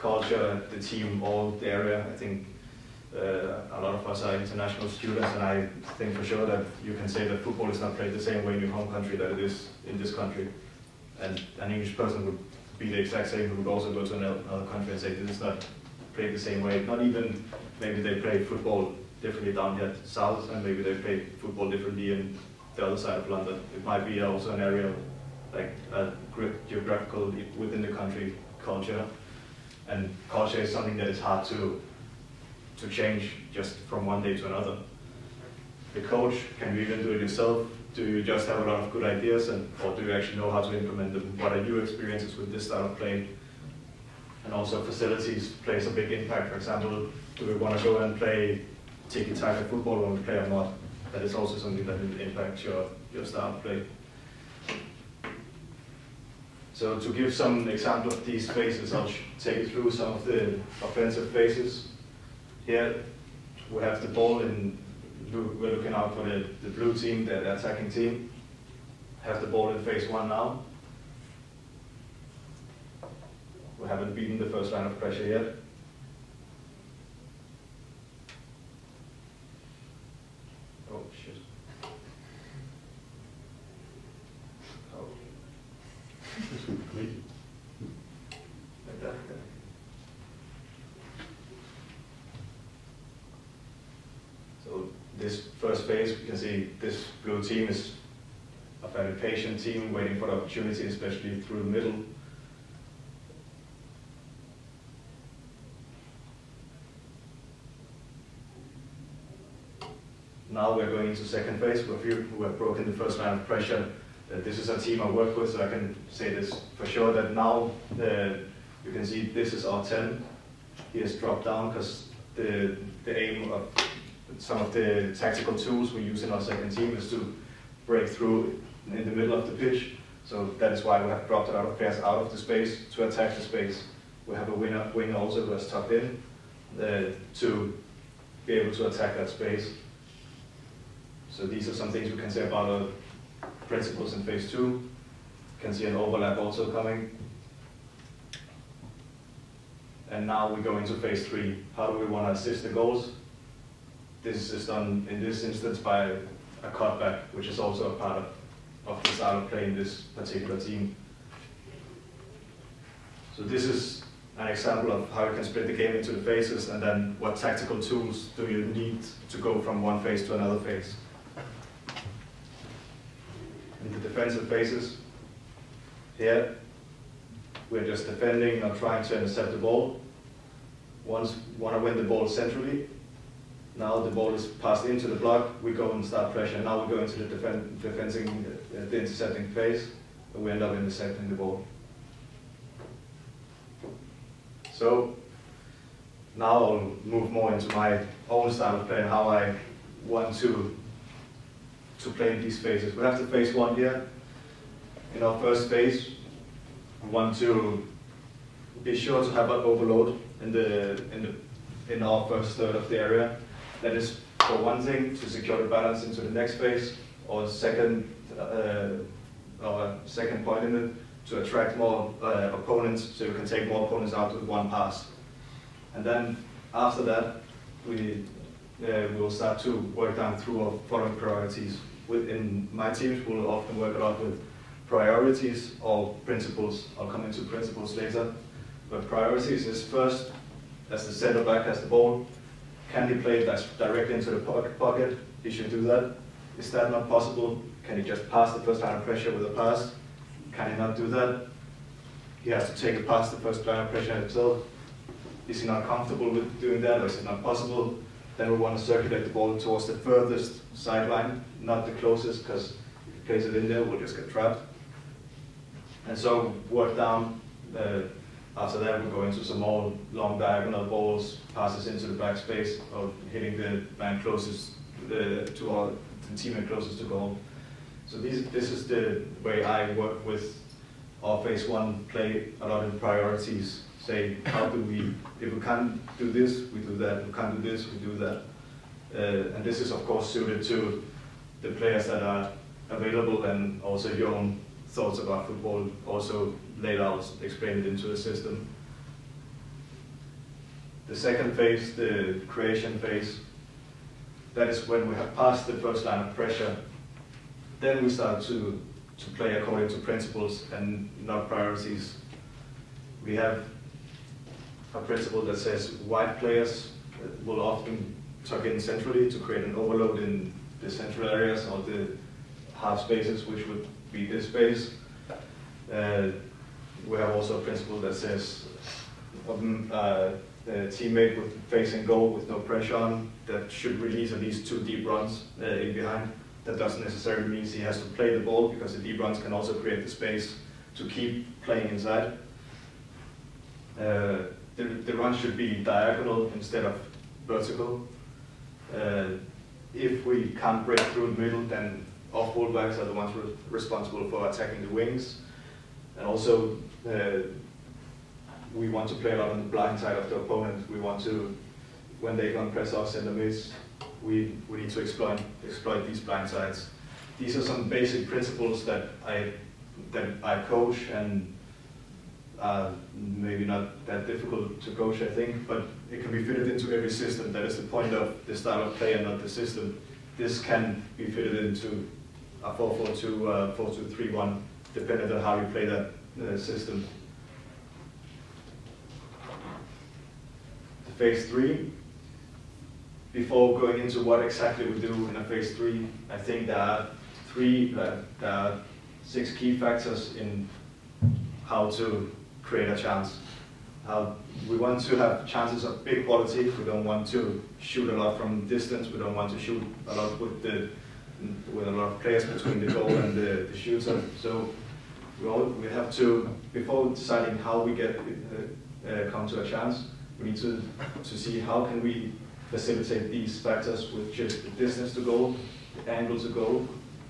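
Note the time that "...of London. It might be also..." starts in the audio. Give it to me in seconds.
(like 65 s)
23 s.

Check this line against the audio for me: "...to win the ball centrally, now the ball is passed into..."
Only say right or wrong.
right.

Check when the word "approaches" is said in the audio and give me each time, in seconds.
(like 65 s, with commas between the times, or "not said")
not said.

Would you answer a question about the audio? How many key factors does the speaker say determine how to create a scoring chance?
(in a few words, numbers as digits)
6.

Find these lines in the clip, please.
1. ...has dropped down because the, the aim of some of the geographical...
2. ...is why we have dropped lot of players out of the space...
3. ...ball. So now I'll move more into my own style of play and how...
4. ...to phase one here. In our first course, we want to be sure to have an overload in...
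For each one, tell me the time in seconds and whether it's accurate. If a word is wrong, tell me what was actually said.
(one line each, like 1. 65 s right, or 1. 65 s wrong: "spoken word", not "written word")
1. 121 s wrong: "tactical", not "geographical"
2. 130 s right
3. 191 s right
4. 203 s wrong: "phase", not "course".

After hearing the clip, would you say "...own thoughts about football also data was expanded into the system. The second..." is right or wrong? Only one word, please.
right.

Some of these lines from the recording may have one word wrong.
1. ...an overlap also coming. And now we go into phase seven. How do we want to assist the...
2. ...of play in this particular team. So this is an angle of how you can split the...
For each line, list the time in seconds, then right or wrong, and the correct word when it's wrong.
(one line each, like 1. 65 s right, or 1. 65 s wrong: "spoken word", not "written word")
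1. 145 s wrong: "three", not "seven"
2. 159 s wrong: "example", not "angle".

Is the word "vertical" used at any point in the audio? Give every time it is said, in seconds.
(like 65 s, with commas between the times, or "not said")
347 s.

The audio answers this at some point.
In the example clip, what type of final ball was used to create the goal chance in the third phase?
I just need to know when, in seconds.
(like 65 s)
156 s.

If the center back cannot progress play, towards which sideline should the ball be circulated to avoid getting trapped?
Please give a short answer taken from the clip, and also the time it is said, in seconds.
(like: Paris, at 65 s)
The furthest sideline, at 259 s.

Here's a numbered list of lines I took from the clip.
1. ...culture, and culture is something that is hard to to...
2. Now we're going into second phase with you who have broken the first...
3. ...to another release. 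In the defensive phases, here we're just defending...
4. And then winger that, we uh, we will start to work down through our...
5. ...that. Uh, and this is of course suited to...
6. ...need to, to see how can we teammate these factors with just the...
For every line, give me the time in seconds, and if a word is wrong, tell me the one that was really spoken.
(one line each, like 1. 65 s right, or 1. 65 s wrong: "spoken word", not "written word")
1. 28 s right
2. 110 s right
3. 170 s wrong: "phase", not "release"
4. 225 s wrong: "after", not "winger"
5. 288 s right
6. 420 s wrong: "facilitate", not "teammate".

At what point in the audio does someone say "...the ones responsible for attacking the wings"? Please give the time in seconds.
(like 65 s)
353 s.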